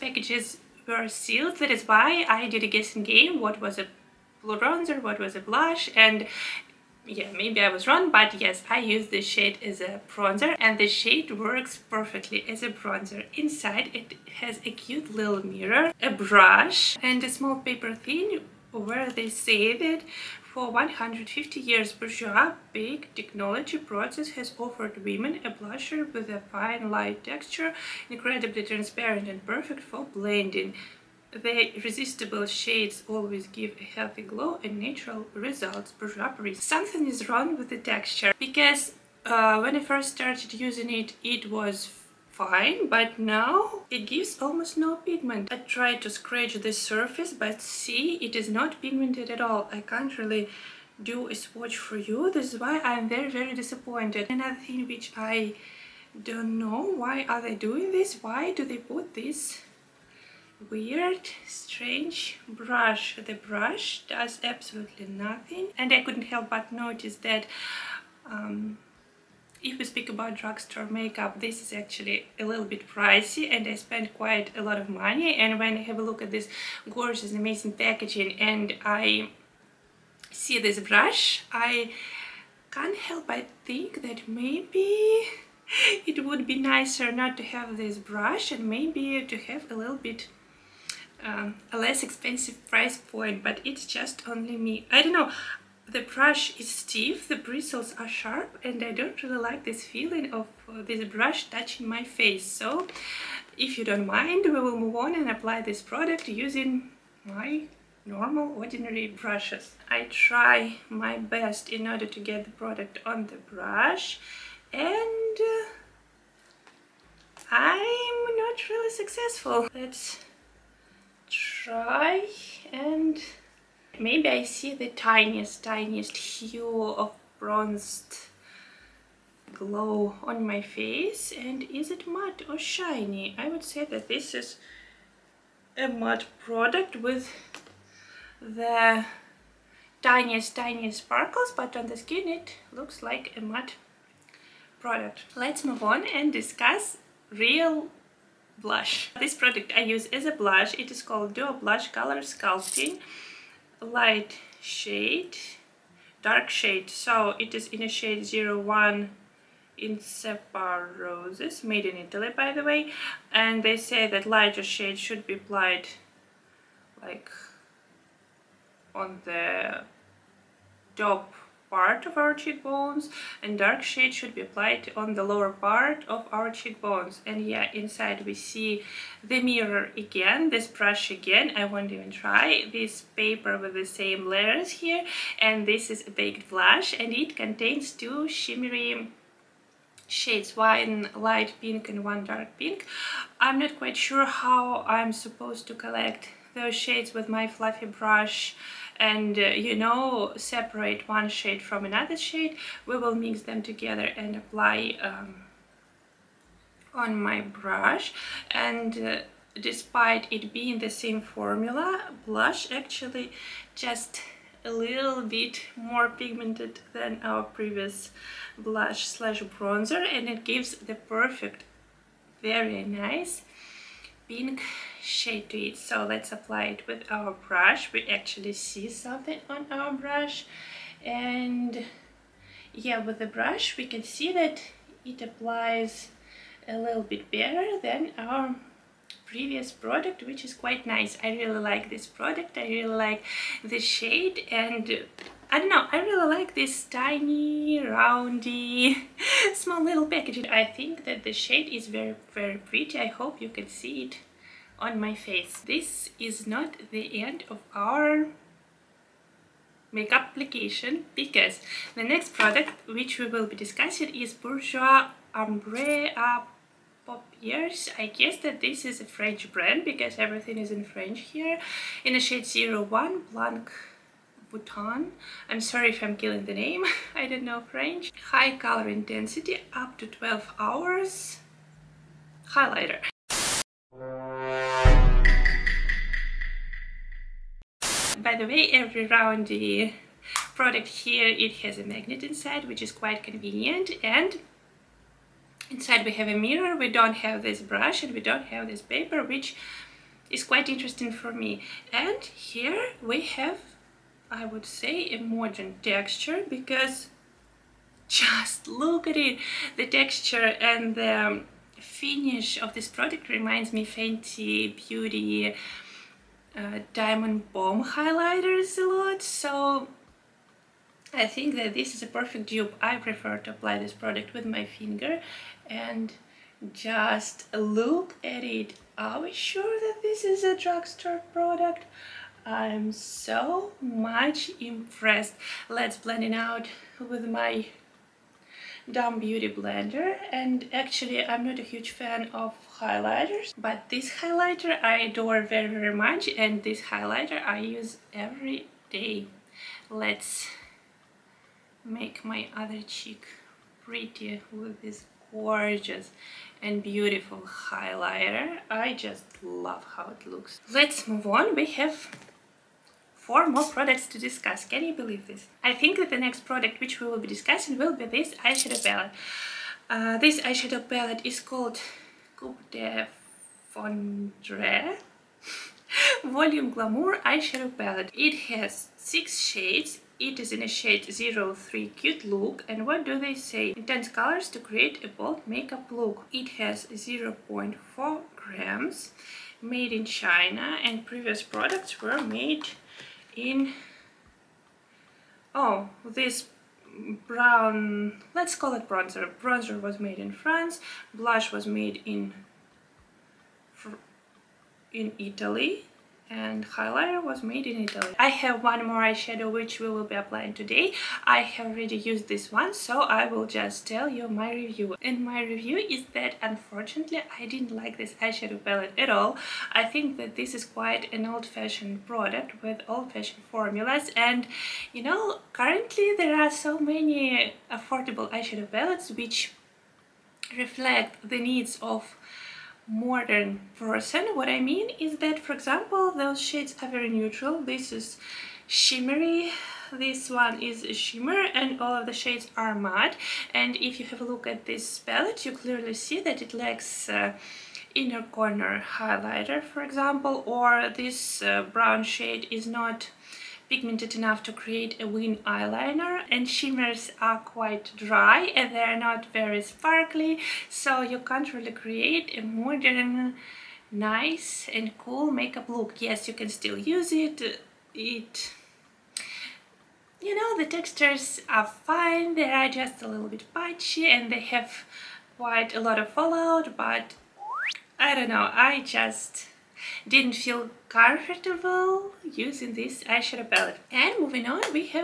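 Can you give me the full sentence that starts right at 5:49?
Let's make my other cheek pretty with this gorgeous and beautiful highlighter.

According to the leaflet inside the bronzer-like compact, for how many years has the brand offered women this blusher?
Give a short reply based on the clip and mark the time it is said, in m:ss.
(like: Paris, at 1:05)
150 years, at 0:20.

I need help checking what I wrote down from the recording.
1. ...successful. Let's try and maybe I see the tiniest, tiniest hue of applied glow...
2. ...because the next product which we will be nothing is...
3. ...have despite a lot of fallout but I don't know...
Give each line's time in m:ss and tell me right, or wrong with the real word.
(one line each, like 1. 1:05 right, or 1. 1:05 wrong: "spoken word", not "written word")
1. 1:58 wrong: "bronzed", not "applied"
2. 4:21 wrong: "discussing", not "nothing"
3. 7:54 wrong: "quite", not "despite".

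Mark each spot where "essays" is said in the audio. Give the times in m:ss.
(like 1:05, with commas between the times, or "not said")
not said.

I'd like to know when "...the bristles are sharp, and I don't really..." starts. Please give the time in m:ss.
1:37.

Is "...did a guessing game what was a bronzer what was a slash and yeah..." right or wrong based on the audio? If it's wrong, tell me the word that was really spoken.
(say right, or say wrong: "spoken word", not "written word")
wrong: "blush", not "slash".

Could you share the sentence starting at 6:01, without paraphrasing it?
We have four more products to discuss.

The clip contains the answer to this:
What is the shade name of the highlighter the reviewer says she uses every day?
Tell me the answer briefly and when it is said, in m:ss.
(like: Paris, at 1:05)
01 Blanc Bouton, at 4:32.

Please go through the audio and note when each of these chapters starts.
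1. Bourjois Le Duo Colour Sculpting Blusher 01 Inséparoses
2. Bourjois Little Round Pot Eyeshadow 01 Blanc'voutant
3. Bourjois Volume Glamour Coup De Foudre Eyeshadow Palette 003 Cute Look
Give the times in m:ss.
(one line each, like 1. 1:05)
1. 2:24
2. 4:21
3. 6:05.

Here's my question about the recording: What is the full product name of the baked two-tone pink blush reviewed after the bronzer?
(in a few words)
Duo Blush Color Sculpting.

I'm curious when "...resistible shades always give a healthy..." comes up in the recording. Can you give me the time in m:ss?
0:31.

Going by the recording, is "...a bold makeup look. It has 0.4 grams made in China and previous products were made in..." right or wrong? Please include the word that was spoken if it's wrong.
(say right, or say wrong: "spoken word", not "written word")
right.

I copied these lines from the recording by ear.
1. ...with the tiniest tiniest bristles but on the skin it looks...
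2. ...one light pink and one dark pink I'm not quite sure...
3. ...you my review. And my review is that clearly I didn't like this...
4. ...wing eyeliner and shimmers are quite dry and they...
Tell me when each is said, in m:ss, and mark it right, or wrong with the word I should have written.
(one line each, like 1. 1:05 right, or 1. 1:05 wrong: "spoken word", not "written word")
1. 2:16 wrong: "sparkles", not "bristles"
2. 3:10 right
3. 6:54 wrong: "unfortunately", not "clearly"
4. 7:35 right.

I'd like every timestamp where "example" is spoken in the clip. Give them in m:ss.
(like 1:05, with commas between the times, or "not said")
7:15, 7:29.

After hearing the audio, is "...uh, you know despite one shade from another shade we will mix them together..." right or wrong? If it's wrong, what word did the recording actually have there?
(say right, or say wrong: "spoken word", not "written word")
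wrong: "separate", not "despite".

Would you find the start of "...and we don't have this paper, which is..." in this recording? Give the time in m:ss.
4:58.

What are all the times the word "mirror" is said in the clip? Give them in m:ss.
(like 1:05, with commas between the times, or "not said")
0:15, 2:59, 4:56.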